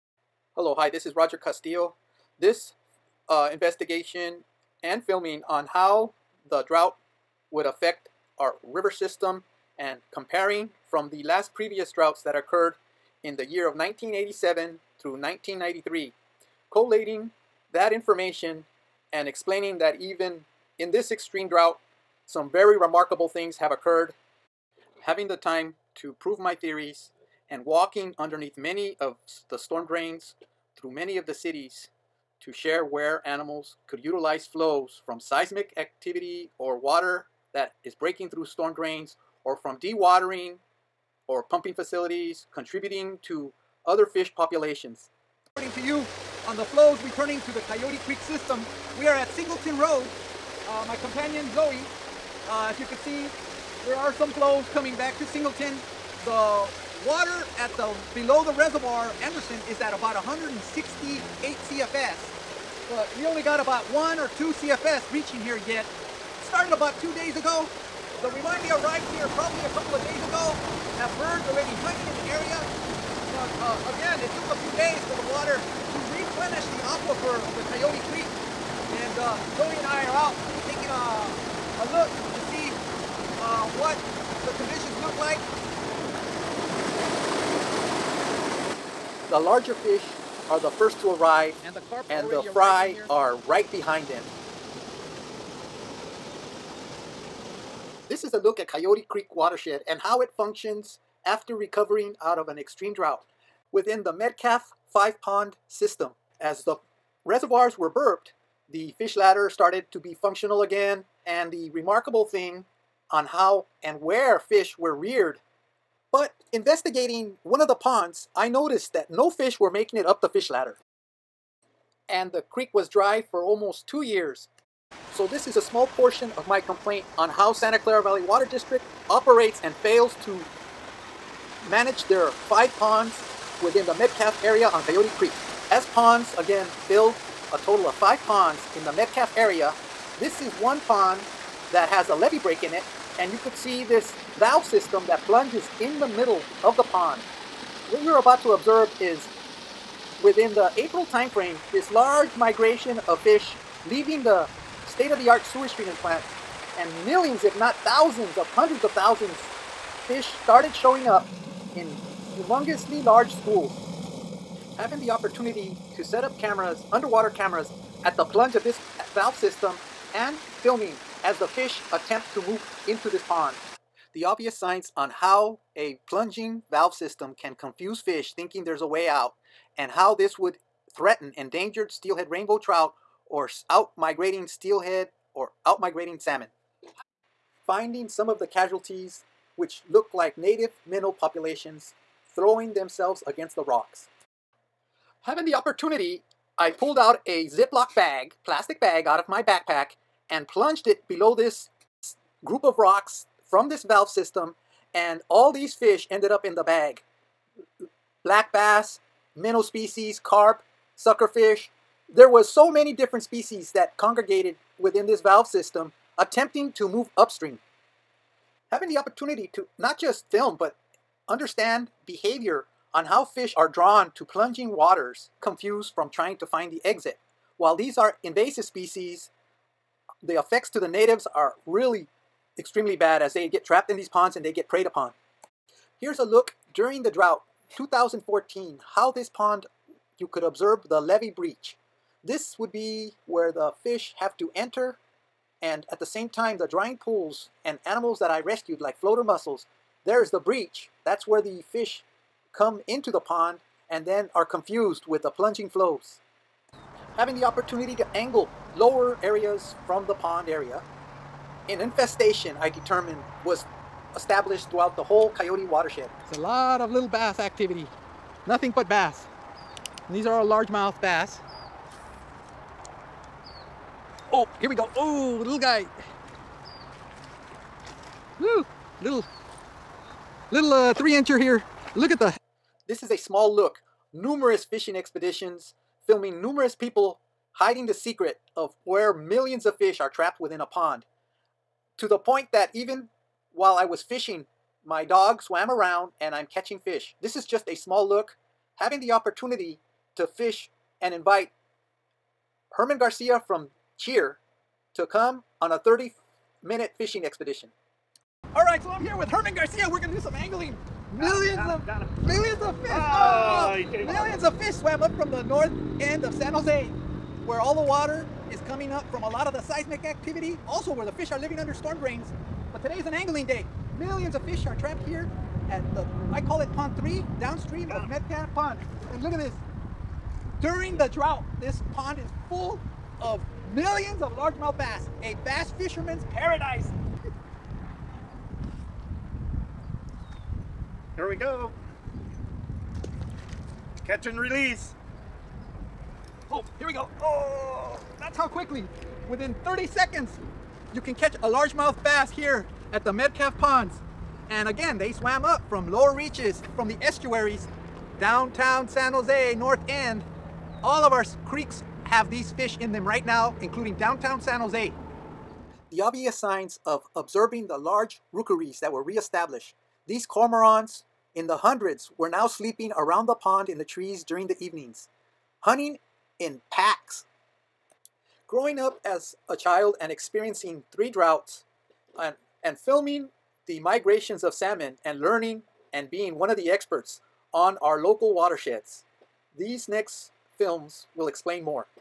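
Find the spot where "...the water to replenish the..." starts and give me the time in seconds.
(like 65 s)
75 s.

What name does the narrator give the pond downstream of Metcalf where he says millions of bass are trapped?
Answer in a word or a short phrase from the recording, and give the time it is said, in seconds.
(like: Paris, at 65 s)
Pond 3, at 326 s.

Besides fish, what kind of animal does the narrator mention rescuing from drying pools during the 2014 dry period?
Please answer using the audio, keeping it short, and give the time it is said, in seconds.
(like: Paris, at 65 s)
floater mussels, at 248 s.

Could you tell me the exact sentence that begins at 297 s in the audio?
This is just a small look.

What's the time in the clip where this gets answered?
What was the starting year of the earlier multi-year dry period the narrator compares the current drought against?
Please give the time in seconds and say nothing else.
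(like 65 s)
13 s.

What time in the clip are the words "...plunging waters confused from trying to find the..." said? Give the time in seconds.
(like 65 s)
224 s.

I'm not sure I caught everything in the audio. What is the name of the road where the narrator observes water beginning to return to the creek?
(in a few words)
Singleton Road.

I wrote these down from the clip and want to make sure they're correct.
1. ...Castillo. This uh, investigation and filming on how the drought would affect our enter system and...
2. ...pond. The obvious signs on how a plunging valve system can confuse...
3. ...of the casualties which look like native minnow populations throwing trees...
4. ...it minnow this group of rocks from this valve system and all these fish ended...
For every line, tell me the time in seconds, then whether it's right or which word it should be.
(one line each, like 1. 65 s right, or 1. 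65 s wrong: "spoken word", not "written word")
1. 1 s wrong: "river", not "enter"
2. 173 s right
3. 188 s wrong: "themselves", not "trees"
4. 200 s wrong: "below", not "minnow".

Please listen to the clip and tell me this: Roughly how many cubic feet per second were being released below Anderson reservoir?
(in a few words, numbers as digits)
168 CFS.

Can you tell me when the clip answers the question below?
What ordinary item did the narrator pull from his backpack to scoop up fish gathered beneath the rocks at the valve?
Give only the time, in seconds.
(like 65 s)
197 s.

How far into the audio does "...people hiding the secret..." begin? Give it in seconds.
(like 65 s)
286 s.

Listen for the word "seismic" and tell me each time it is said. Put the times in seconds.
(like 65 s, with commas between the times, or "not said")
35 s, 319 s.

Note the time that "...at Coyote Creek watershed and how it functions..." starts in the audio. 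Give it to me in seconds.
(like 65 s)
98 s.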